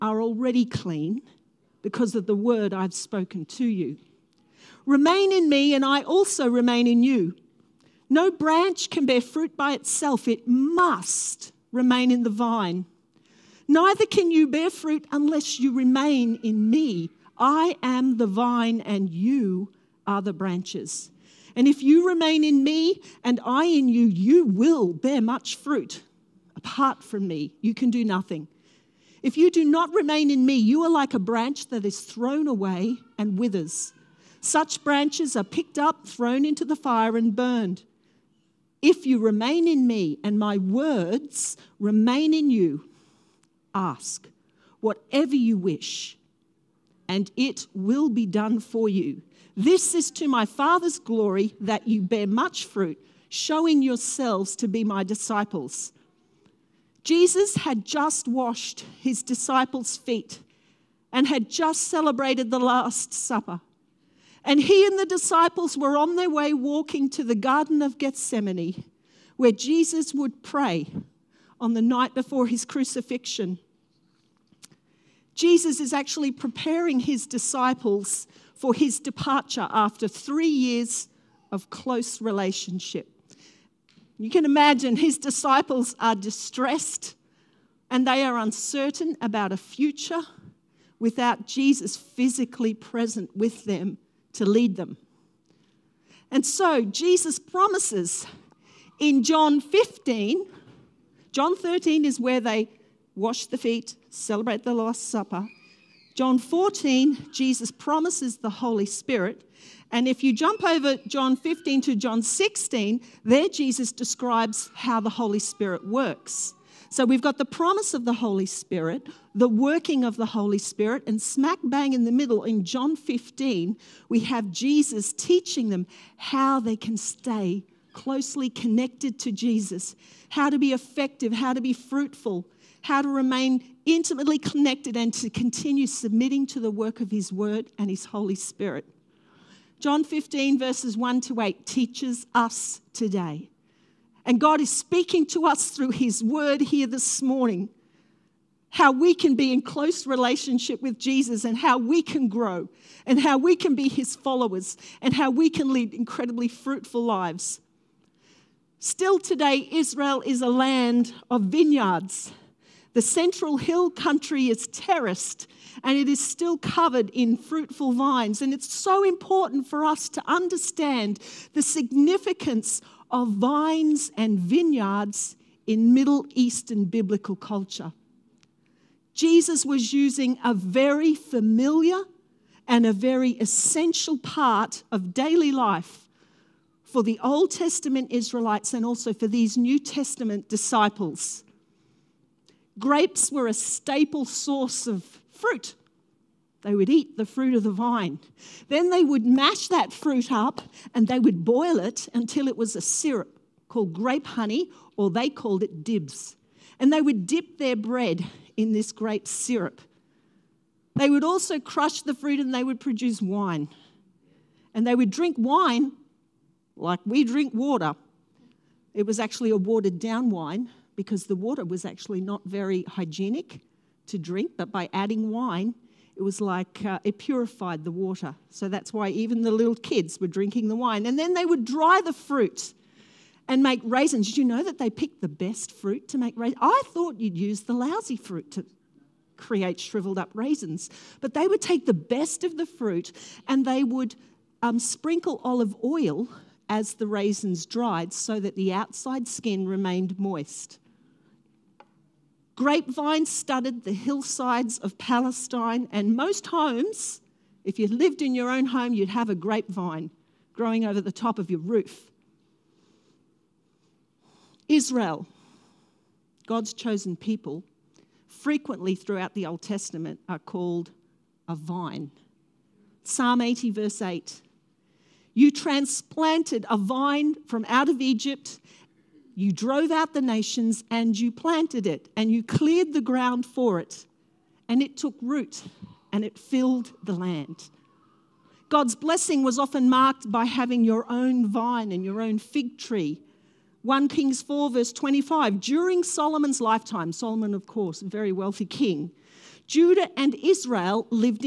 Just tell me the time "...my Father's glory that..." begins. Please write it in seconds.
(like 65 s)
50 s.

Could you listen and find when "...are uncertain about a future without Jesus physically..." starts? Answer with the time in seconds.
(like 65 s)
88 s.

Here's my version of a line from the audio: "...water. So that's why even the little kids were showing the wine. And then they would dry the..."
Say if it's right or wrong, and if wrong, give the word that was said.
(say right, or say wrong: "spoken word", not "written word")
wrong: "drinking", not "showing".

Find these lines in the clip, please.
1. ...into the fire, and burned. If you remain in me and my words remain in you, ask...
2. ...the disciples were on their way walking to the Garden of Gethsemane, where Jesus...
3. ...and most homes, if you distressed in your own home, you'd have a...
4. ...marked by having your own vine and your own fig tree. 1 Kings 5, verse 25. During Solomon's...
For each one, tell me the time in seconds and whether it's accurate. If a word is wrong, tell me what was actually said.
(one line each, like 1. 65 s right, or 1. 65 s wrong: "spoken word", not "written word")
1. 36 s right
2. 64 s right
3. 255 s wrong: "lived", not "distressed"
4. 289 s wrong: "4", not "5".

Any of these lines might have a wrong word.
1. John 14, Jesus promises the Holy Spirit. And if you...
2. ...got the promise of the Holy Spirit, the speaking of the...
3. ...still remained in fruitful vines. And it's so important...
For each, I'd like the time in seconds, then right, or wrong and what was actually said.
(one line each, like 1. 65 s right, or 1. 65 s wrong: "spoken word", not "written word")
1. 106 s right
2. 117 s wrong: "working", not "speaking"
3. 166 s wrong: "covered", not "remained".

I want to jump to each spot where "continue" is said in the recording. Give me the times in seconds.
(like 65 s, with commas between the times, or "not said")
135 s.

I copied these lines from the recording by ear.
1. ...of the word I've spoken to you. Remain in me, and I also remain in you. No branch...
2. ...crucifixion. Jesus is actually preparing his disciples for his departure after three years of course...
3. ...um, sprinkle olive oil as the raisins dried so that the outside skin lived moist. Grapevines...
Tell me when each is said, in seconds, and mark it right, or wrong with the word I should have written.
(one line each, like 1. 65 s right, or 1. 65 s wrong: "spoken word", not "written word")
1. 2 s right
2. 72 s wrong: "close", not "course"
3. 244 s wrong: "remained", not "lived".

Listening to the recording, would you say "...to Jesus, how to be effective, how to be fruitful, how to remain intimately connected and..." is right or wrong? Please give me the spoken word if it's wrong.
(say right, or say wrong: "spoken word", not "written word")
right.